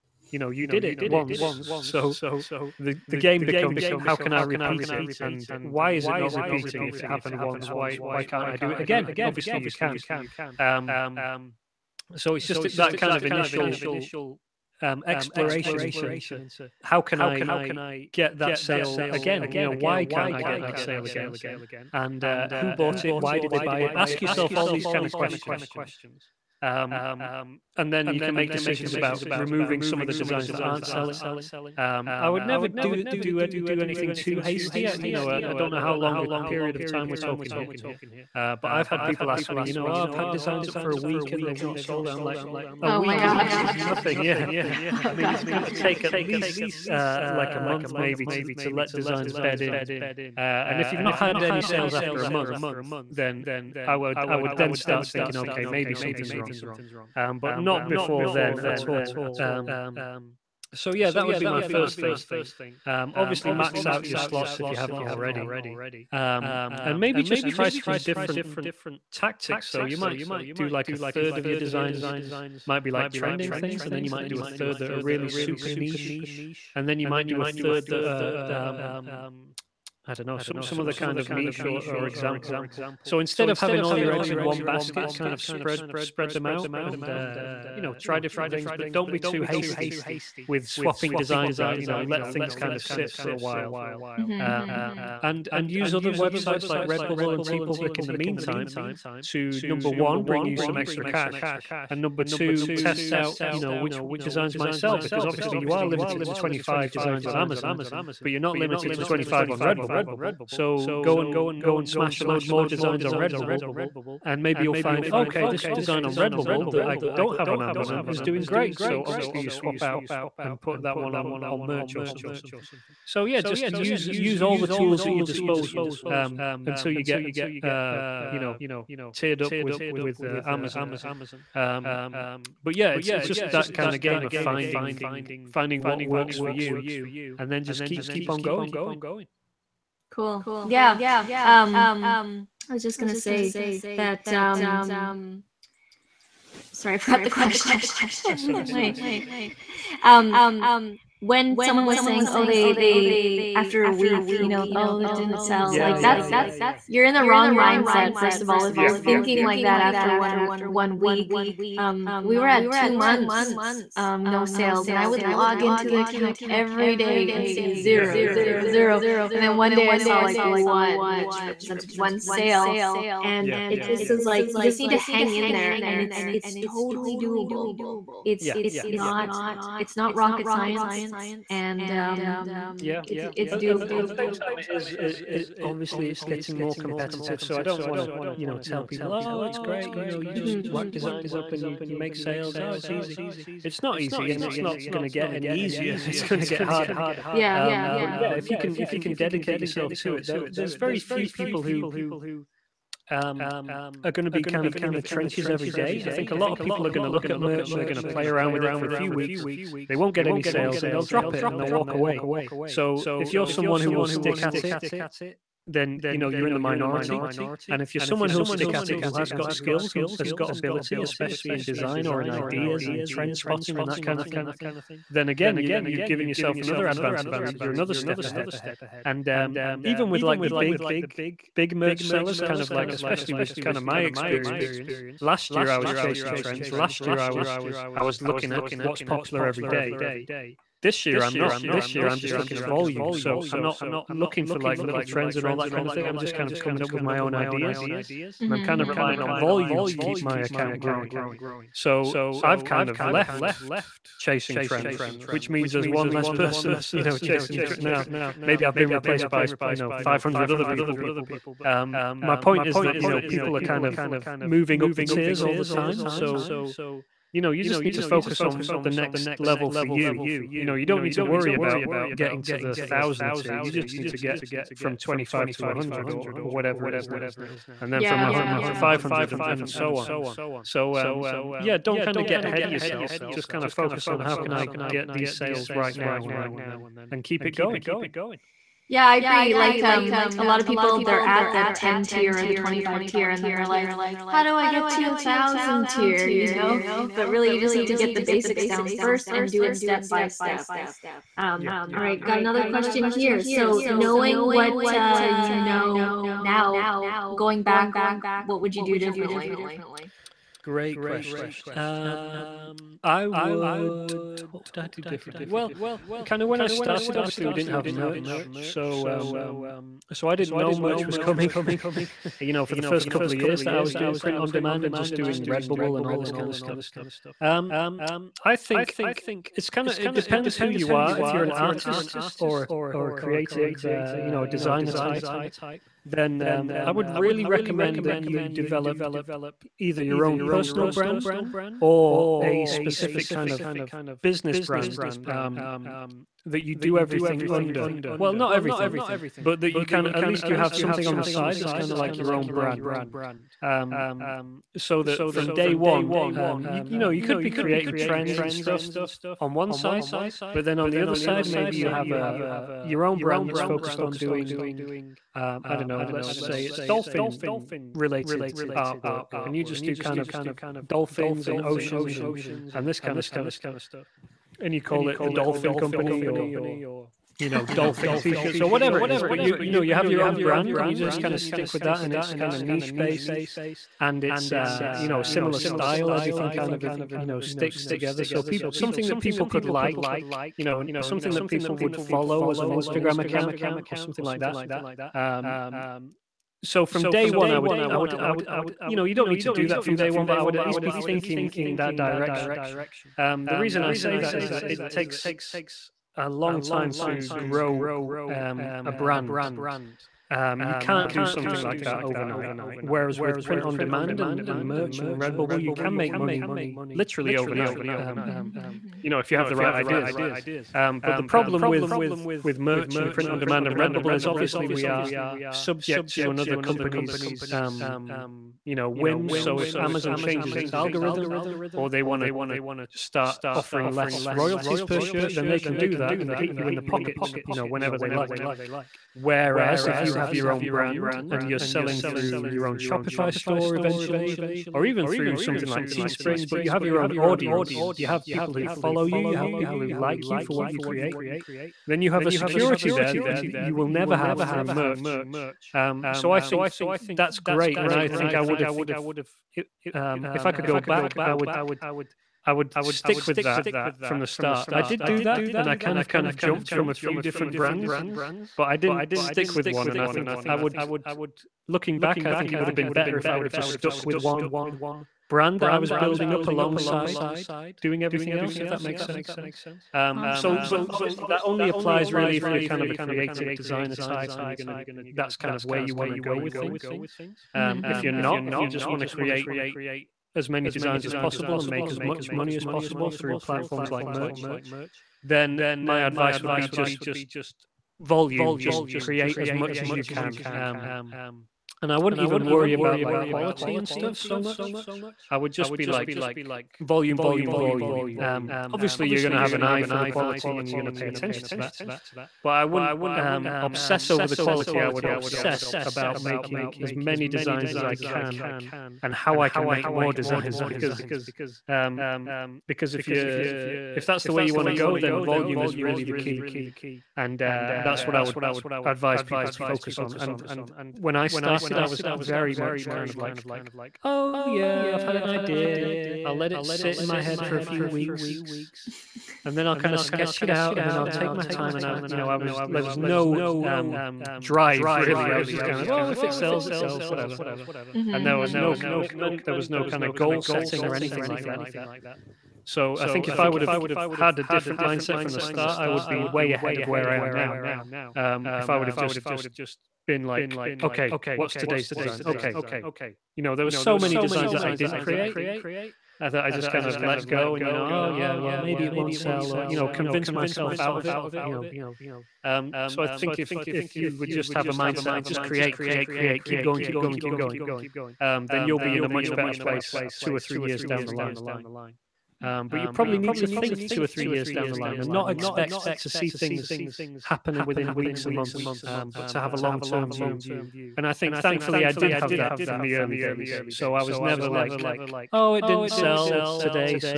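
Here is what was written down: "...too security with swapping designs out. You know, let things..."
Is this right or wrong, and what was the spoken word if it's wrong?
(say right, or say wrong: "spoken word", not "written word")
wrong: "hasty", not "security".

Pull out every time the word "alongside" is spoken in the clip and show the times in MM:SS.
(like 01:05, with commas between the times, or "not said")
07:56.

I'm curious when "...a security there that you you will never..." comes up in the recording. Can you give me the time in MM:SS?
07:32.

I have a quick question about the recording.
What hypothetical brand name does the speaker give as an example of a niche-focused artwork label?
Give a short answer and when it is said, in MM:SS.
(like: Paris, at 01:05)
the dolphin company, at 06:15.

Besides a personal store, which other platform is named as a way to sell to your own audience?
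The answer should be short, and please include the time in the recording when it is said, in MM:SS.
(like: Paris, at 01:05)
Teespring, at 07:25.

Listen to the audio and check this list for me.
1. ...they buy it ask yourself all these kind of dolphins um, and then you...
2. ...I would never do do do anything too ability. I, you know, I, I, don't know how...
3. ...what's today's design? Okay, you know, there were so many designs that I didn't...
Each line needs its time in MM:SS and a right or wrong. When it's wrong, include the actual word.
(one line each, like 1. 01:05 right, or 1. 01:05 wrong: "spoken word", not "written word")
1. 00:23 wrong: "questions", not "dolphins"
2. 00:32 wrong: "hasty", not "ability"
3. 09:21 right.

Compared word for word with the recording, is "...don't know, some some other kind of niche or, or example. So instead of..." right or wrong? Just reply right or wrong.
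right.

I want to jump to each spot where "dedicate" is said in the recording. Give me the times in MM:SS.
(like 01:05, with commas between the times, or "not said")
03:19.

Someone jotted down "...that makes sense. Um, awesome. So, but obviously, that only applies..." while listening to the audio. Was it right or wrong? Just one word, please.
right.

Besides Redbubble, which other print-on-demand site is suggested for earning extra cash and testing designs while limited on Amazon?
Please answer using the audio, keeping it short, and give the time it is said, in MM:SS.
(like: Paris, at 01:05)
TeePublic, at 01:37.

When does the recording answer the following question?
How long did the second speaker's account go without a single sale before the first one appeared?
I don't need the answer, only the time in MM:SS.
02:42.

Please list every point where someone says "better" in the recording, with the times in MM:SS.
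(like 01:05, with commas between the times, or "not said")
07:52, 09:39.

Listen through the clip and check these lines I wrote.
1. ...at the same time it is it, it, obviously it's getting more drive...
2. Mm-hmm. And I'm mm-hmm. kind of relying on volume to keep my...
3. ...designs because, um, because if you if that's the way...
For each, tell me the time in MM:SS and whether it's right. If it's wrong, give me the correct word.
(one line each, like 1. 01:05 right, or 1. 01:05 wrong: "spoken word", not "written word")
1. 03:03 wrong: "competitive", not "drive"
2. 04:08 right
3. 08:40 right.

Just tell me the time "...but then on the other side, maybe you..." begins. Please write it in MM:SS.
06:00.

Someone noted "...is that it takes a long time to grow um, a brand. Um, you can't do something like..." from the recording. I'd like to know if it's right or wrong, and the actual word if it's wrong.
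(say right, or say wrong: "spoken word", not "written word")
right.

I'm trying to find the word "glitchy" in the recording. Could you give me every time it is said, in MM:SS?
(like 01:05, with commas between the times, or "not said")
not said.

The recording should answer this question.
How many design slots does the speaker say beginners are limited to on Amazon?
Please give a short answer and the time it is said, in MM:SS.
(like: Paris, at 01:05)
25, at 01:46.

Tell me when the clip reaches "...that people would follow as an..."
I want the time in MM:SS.
06:31.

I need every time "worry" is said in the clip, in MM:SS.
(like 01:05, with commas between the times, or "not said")
04:31, 08:22.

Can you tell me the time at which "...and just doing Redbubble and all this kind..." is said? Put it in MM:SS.
05:24.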